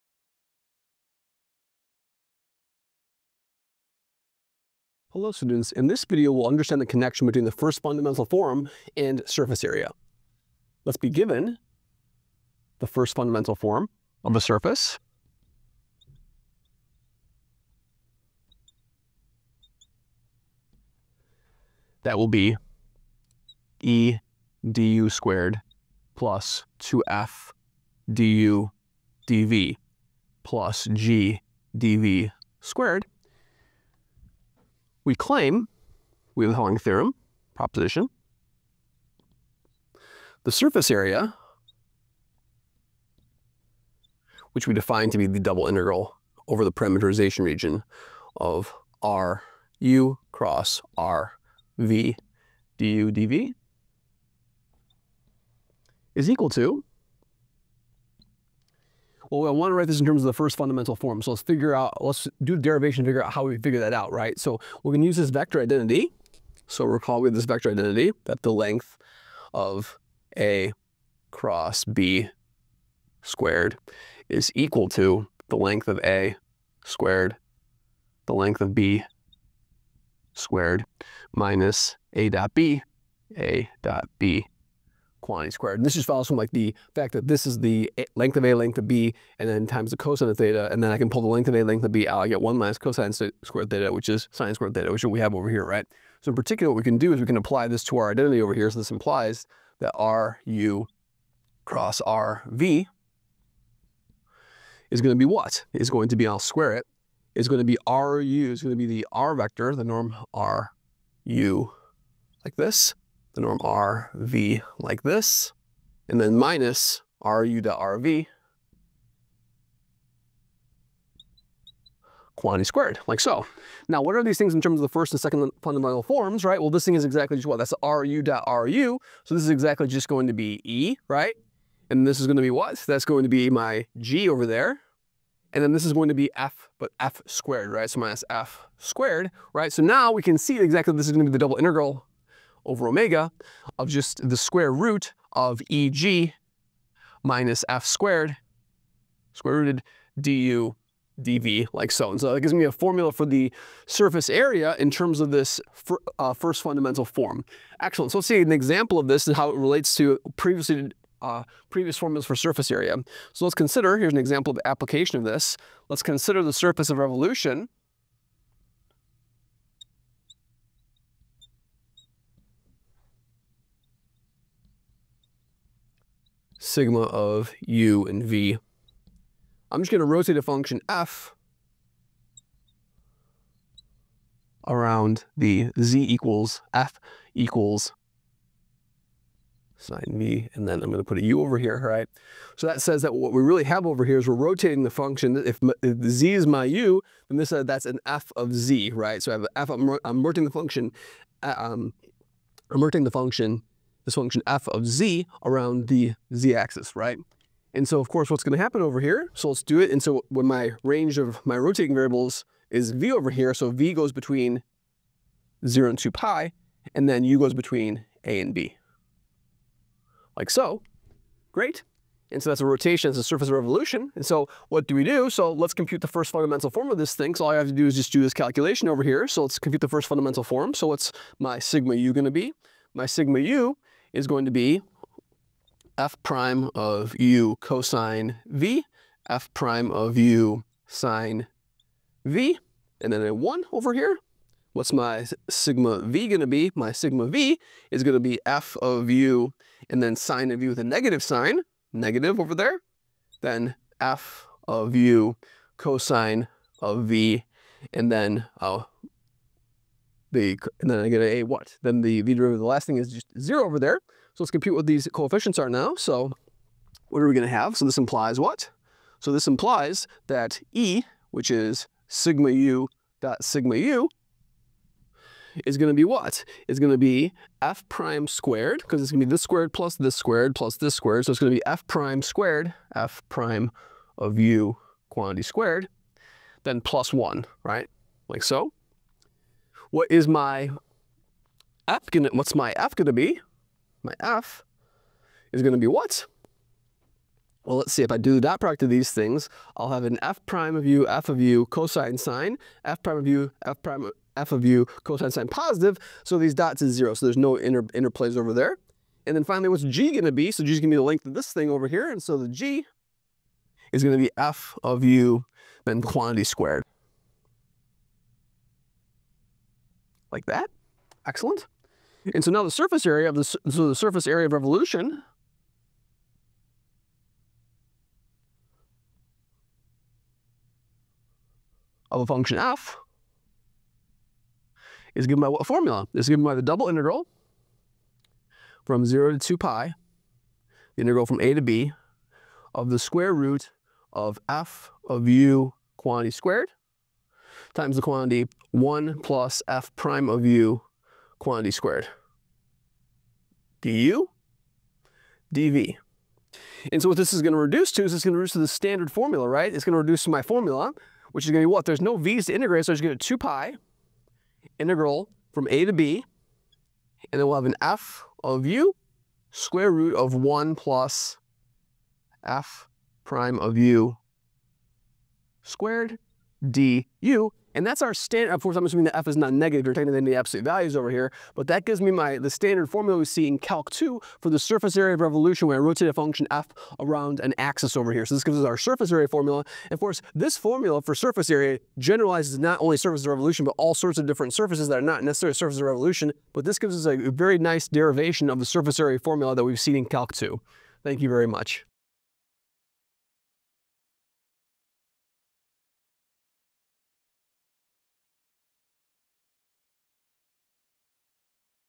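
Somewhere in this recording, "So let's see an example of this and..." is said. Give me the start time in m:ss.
2:38.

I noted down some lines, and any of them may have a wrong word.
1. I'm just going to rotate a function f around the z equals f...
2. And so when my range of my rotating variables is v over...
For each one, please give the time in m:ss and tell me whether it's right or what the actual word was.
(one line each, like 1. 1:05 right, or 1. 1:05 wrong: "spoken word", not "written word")
1. 2:59 right
2. 3:29 right.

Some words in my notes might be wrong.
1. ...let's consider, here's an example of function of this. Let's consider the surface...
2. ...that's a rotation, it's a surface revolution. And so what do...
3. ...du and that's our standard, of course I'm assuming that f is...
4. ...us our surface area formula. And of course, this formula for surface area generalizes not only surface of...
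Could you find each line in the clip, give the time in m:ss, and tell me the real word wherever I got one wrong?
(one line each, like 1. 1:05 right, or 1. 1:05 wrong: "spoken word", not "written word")
1. 2:43 wrong: "application", not "function"
2. 3:42 right
3. 6:16 right
4. 6:28 right.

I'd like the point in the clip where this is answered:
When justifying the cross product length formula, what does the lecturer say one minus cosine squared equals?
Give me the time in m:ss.
1:34.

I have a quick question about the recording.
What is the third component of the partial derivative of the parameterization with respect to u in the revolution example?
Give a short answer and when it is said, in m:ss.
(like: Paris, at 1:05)
1, at 4:03.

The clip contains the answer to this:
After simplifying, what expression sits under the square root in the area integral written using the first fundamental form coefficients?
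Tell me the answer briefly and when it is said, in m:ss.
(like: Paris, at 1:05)
EG minus F squared, at 2:25.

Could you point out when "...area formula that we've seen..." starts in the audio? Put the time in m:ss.
6:38.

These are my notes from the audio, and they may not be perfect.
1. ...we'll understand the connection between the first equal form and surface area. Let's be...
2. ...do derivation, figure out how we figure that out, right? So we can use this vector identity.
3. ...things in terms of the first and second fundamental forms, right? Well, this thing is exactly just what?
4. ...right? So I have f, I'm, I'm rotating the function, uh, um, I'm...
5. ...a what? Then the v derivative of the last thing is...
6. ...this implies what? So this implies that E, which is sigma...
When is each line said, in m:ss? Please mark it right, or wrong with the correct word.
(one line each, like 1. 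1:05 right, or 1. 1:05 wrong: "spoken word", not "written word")
1. 0:06 wrong: "fundamental", not "equal"
2. 1:02 right
3. 2:04 right
4. 3:18 right
5. 4:21 right
6. 4:27 right.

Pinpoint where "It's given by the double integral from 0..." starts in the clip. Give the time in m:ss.
5:36.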